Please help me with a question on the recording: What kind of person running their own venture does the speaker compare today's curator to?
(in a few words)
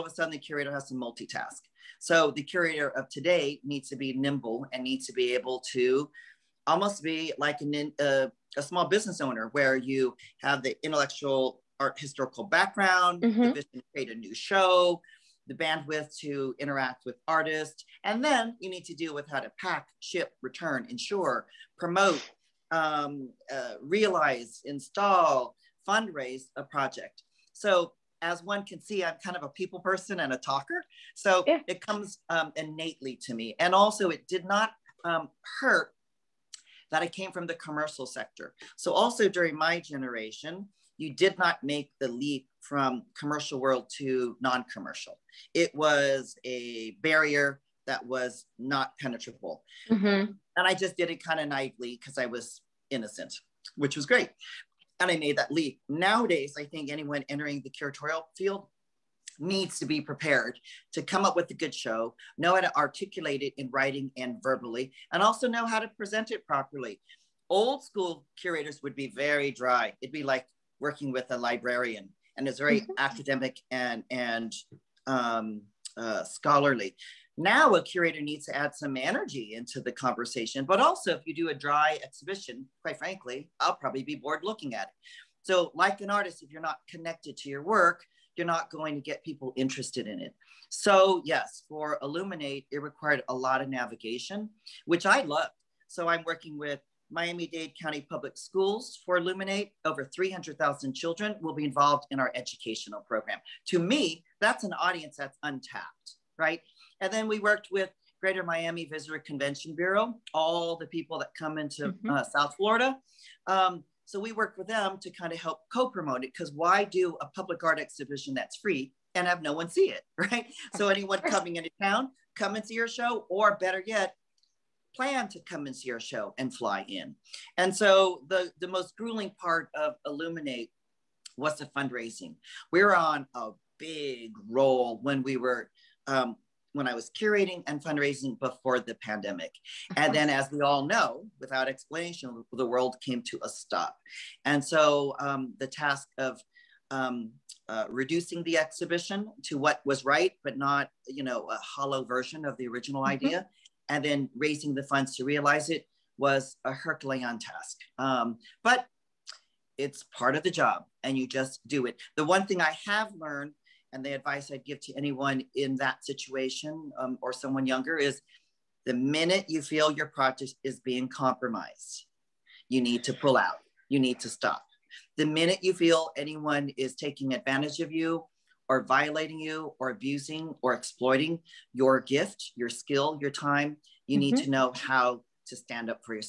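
Small business owner.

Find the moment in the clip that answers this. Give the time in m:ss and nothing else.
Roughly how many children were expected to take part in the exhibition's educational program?
1:40.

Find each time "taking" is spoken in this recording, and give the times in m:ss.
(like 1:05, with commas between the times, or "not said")
2:56.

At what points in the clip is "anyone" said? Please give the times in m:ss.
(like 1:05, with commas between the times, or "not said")
0:56, 2:00, 2:44, 2:56.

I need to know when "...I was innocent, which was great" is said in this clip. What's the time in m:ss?
0:52.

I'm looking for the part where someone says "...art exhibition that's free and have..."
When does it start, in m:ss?
1:57.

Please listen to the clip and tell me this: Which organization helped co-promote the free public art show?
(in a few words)
Greater Miami Visitor Convention Bureau.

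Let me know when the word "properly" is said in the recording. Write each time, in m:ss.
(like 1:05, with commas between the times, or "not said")
1:06.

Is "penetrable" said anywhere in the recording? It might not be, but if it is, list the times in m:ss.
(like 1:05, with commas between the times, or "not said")
0:48.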